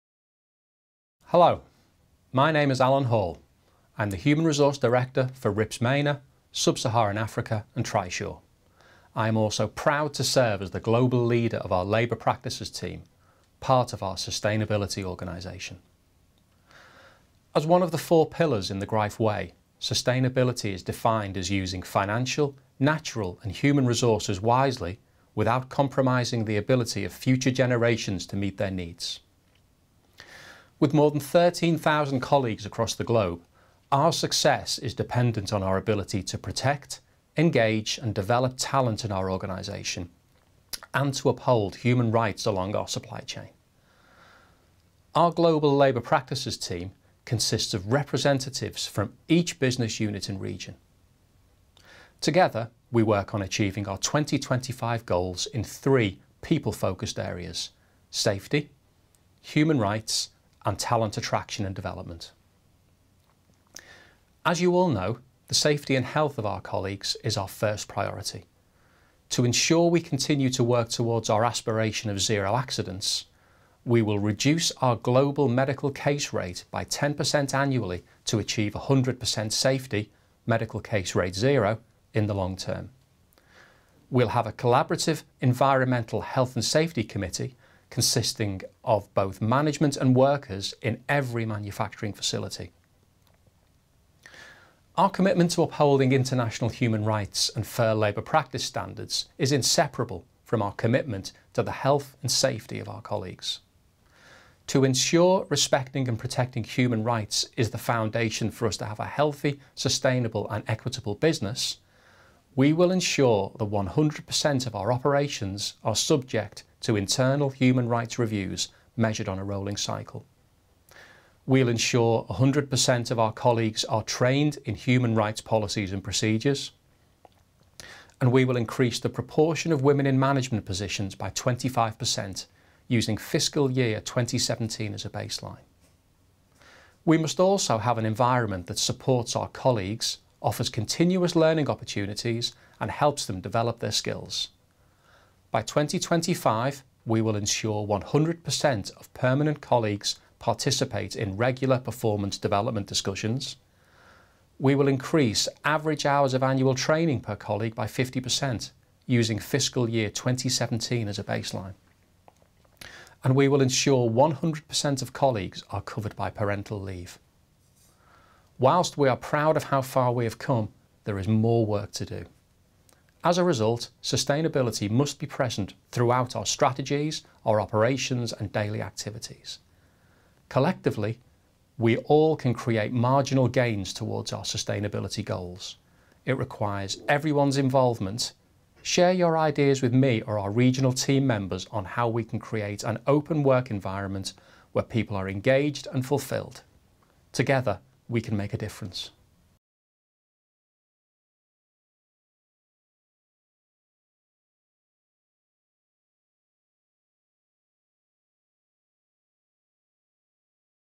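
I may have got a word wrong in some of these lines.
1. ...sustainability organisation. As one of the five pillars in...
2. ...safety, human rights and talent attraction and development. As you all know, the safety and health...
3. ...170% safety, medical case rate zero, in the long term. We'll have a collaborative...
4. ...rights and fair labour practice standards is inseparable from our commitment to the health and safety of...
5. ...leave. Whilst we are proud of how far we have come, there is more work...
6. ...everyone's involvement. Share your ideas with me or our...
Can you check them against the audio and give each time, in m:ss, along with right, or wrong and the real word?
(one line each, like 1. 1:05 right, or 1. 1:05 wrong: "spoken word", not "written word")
1. 0:14 wrong: "four", not "five"
2. 0:58 right
3. 1:18 wrong: "100", not "170"
4. 1:37 right
5. 2:46 right
6. 3:07 right.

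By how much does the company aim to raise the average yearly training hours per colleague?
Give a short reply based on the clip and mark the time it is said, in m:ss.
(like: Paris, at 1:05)
50%, at 2:37.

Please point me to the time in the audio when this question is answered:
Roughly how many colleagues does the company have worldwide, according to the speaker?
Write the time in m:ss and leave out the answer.
0:31.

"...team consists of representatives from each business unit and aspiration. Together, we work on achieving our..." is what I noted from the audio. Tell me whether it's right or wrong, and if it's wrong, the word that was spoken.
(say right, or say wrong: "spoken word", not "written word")
wrong: "region", not "aspiration".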